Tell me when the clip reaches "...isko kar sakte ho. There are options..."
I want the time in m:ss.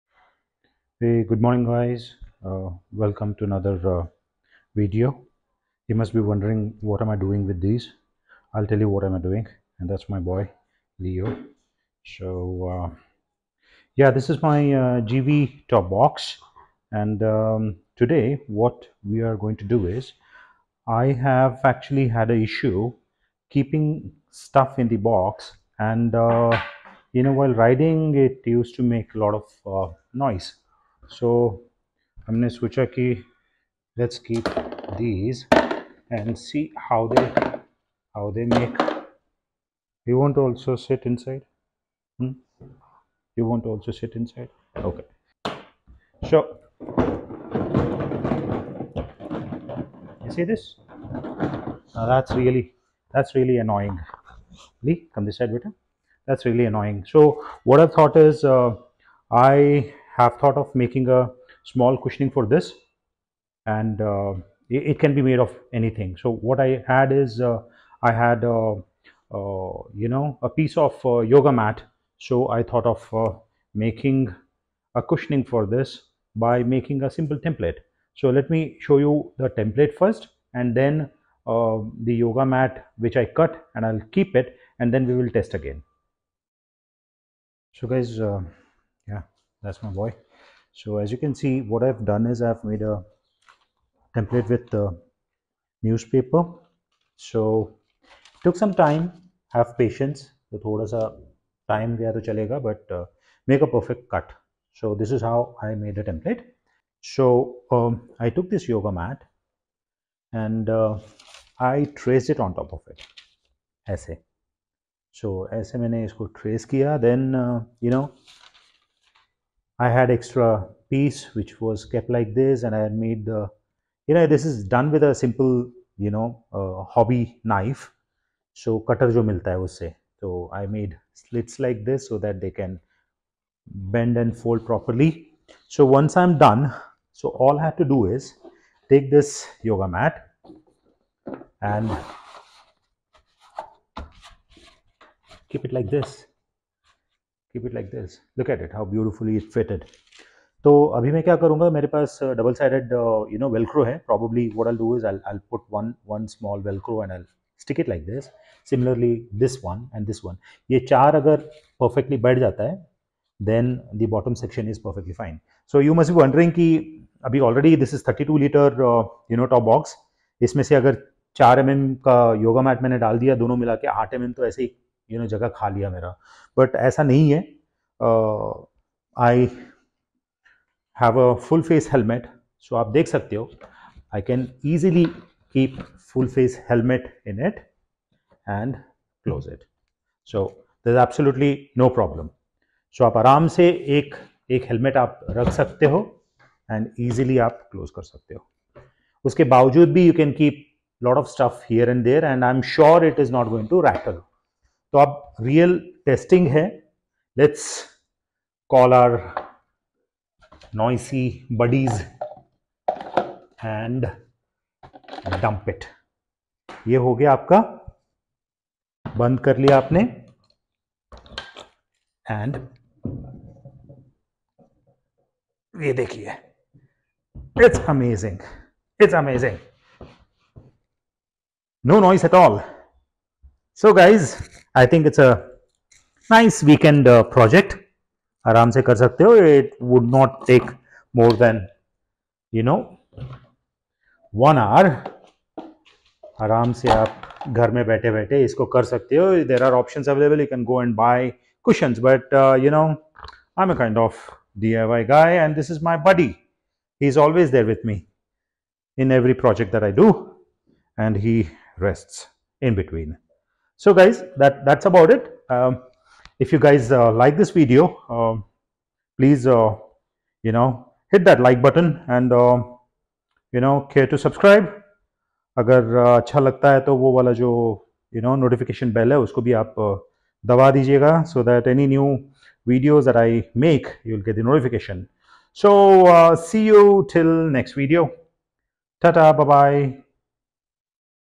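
4:08.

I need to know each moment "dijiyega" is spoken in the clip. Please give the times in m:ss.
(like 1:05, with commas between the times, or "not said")
4:40.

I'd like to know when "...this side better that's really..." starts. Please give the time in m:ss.
0:55.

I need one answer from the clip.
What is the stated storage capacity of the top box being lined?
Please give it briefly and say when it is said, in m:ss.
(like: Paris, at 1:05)
32 liters, at 2:48.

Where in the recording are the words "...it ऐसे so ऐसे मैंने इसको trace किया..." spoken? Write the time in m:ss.
1:52.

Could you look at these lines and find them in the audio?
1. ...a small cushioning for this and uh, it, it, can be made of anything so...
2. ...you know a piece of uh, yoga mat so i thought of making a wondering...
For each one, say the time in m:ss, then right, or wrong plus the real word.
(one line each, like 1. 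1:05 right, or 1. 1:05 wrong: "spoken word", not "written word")
1. 1:01 right
2. 1:09 wrong: "cushioning", not "wondering".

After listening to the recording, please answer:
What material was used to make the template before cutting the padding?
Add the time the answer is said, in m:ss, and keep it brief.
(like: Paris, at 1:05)
newspaper, at 1:35.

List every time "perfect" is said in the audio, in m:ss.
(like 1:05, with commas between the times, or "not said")
1:43.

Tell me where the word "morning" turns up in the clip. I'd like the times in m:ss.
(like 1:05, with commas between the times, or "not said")
0:01.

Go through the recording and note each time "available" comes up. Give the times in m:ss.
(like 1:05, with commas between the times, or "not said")
4:10.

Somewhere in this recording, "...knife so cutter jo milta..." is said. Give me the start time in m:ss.
2:07.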